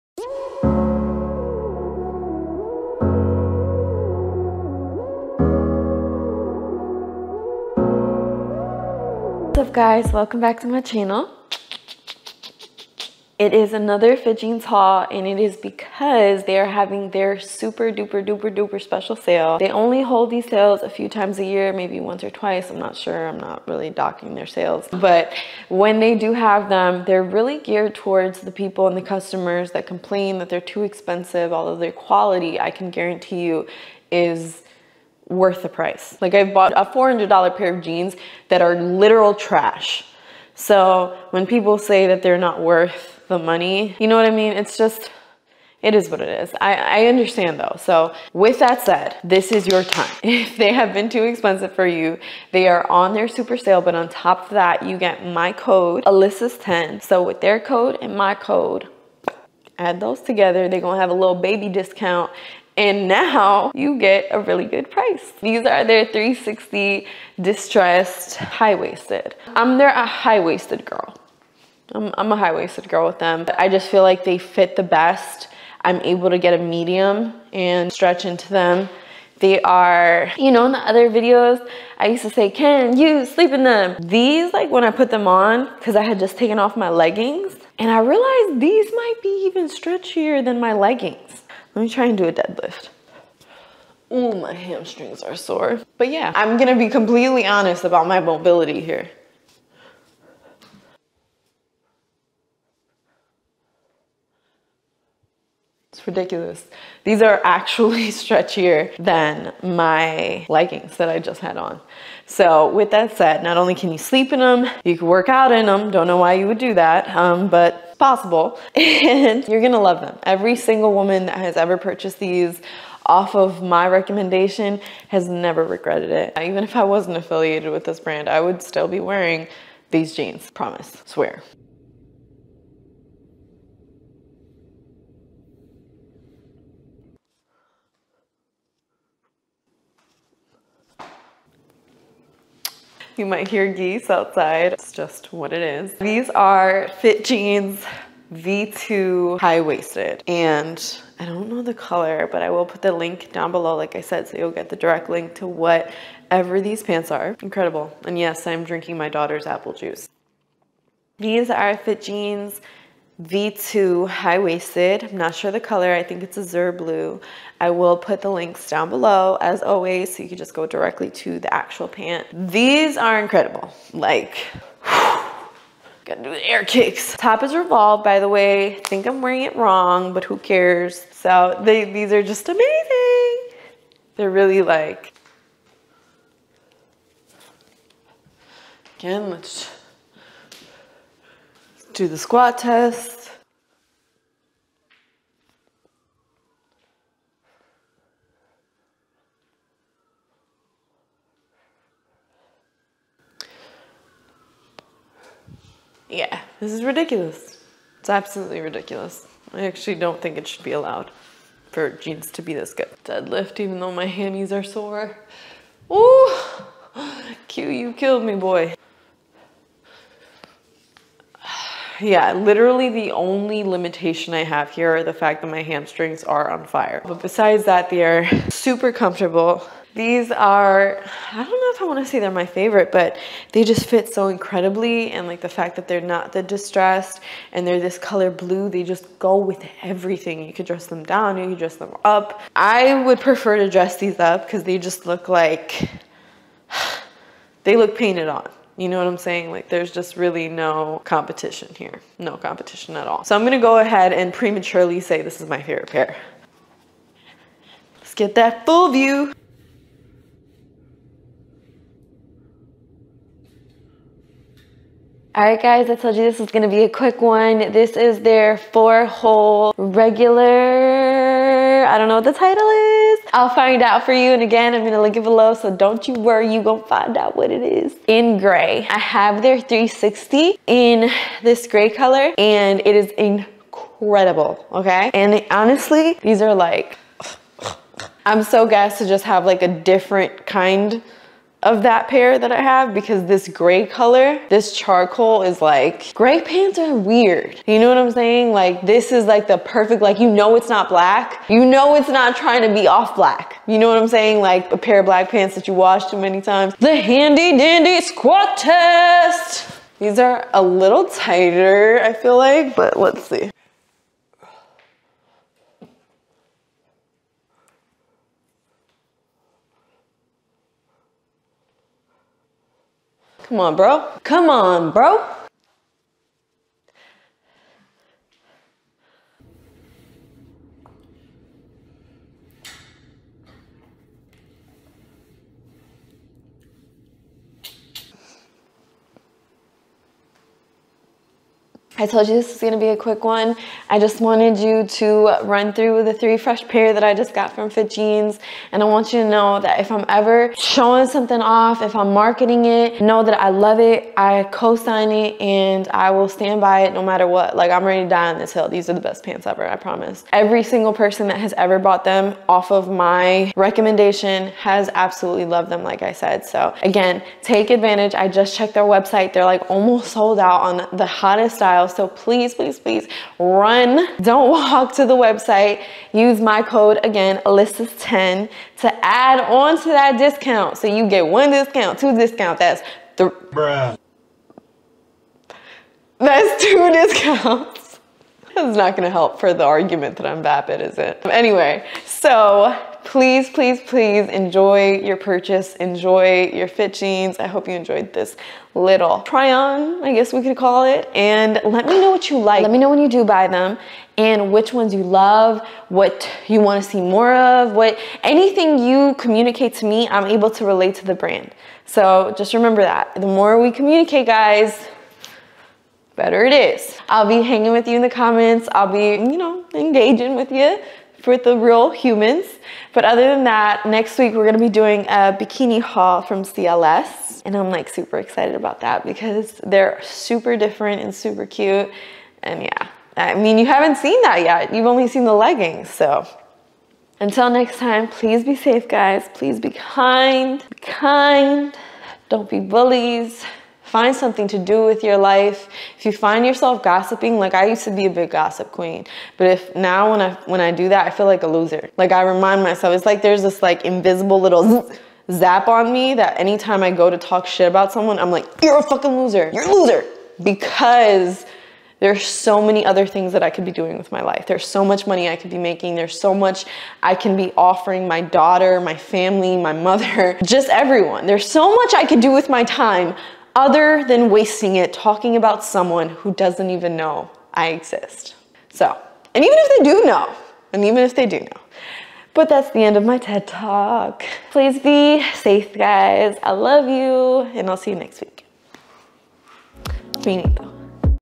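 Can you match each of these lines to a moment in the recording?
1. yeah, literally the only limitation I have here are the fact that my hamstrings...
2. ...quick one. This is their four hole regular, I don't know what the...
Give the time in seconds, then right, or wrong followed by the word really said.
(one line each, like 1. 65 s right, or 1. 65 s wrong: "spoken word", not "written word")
1. 222 s right
2. 266 s right.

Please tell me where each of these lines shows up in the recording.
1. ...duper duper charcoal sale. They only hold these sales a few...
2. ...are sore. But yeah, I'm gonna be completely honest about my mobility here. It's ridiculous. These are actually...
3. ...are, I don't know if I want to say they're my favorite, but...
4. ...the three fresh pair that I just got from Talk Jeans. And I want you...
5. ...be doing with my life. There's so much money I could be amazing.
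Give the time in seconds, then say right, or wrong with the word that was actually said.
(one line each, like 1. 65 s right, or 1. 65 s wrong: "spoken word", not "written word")
1. 18 s wrong: "special", not "charcoal"
2. 95 s right
3. 230 s right
4. 346 s wrong: "Fit", not "Talk"
5. 463 s wrong: "making", not "amazing".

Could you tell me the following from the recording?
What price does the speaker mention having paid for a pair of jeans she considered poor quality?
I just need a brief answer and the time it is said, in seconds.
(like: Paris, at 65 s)
$400, at 36 s.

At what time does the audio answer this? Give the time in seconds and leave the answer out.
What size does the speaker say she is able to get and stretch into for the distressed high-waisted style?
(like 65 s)
76 s.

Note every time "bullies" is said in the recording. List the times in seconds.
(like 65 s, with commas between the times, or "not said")
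442 s.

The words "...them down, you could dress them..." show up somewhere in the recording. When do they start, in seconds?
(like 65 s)
240 s.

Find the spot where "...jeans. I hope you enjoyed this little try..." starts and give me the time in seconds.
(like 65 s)
396 s.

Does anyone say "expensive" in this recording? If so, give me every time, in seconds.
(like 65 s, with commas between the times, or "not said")
30 s, 51 s.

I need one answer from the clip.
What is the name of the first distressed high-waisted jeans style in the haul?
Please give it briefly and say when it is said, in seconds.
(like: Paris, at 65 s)
360, at 66 s.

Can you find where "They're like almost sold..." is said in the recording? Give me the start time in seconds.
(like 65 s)
369 s.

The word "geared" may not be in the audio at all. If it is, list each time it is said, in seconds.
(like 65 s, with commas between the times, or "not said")
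27 s.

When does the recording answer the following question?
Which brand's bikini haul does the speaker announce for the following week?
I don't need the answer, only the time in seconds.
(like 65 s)
426 s.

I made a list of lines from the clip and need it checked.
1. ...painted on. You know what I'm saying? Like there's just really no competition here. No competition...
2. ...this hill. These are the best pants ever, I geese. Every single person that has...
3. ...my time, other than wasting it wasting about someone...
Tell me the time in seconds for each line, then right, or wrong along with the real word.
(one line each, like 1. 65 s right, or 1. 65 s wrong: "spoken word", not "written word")
1. 247 s right
2. 358 s wrong: "promise", not "geese"
3. 472 s wrong: "talking", not "wasting".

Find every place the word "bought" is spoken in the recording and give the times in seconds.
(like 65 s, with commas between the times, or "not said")
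36 s, 361 s.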